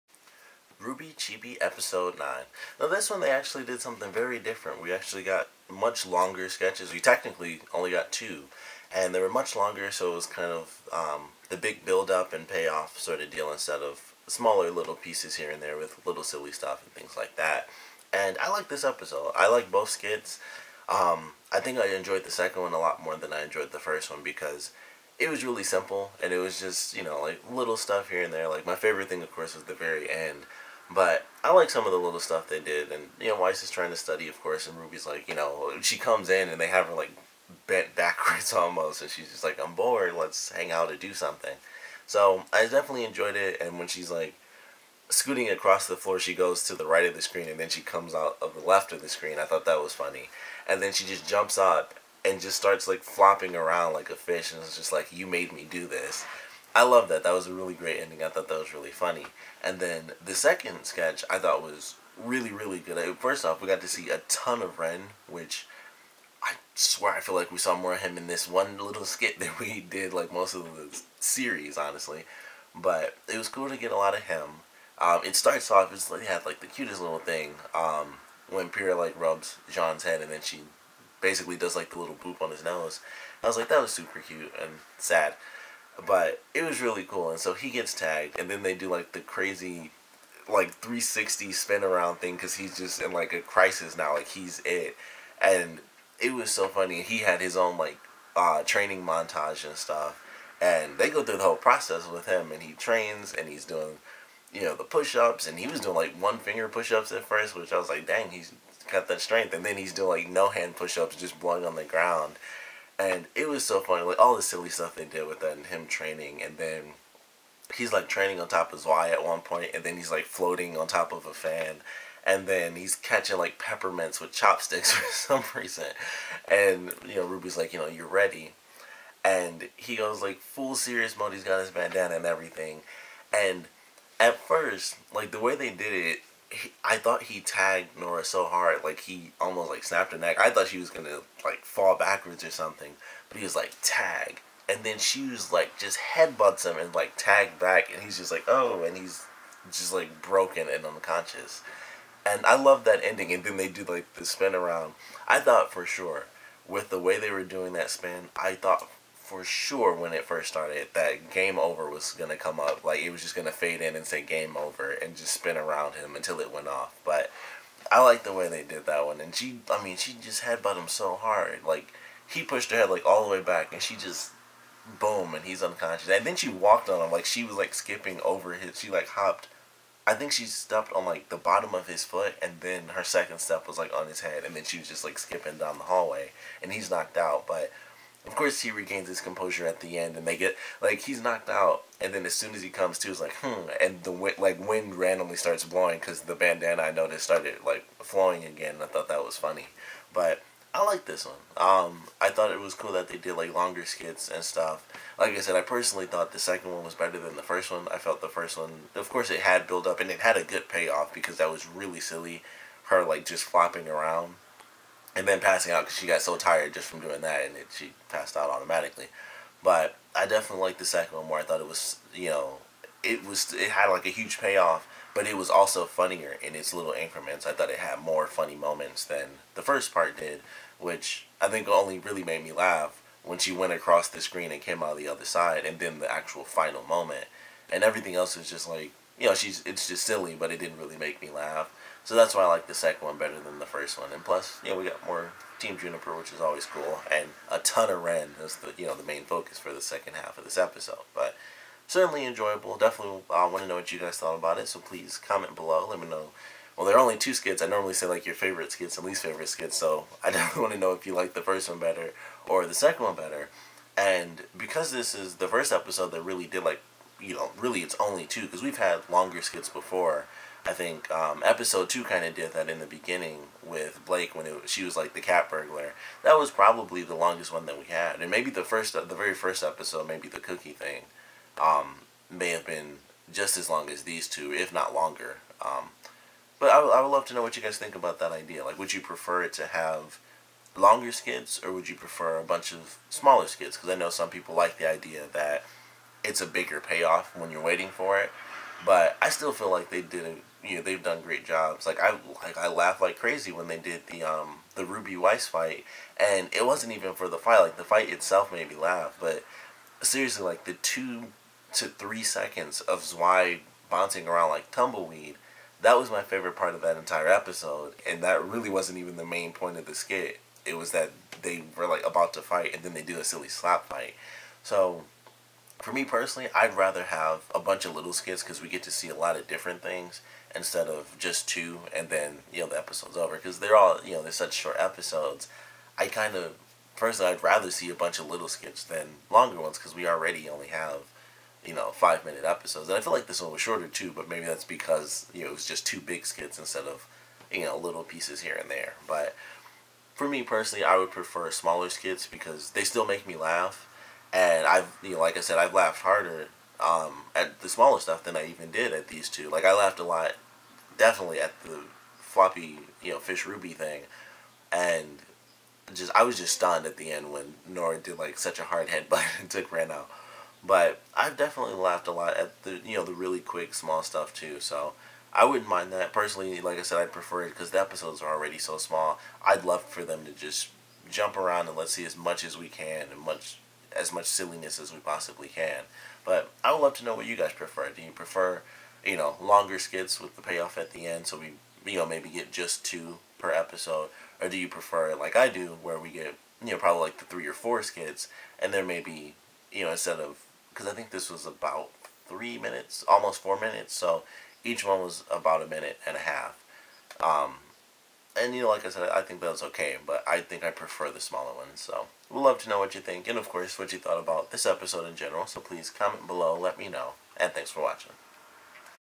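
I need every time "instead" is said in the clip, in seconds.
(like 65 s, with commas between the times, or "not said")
13 s, 330 s, 346 s, 399 s.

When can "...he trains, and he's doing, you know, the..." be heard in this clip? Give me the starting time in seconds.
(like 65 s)
102 s.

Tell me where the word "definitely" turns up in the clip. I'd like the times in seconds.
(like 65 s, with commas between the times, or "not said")
42 s, 220 s, 252 s, 260 s, 360 s, 371 s.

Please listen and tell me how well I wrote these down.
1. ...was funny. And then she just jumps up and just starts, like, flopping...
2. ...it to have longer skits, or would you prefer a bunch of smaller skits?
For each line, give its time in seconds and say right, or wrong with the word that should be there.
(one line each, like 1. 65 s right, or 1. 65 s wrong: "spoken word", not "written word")
1. 49 s right
2. 289 s right.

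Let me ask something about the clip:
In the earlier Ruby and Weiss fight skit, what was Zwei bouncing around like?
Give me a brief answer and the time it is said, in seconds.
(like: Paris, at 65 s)
Tumbleweed, at 314 s.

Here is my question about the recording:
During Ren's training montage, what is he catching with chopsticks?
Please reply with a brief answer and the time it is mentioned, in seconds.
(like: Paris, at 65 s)
Peppermints, at 123 s.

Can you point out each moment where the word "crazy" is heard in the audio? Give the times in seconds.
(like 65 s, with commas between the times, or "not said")
89 s, 303 s.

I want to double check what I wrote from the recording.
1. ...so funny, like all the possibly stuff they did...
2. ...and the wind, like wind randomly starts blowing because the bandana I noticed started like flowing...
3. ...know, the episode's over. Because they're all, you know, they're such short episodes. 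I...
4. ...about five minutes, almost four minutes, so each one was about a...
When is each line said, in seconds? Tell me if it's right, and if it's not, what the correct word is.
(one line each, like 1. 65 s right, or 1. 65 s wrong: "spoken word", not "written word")
1. 113 s wrong: "silly", not "possibly"
2. 193 s right
3. 332 s right
4. 401 s wrong: "three", not "five".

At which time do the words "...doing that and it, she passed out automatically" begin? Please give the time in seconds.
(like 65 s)
216 s.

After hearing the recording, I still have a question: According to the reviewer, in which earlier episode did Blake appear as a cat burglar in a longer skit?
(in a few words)
Episode 2.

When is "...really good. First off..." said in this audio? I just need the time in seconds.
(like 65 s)
62 s.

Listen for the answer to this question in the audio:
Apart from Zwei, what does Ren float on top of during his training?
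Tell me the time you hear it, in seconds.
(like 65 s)
121 s.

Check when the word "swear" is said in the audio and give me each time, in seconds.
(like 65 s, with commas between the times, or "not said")
66 s.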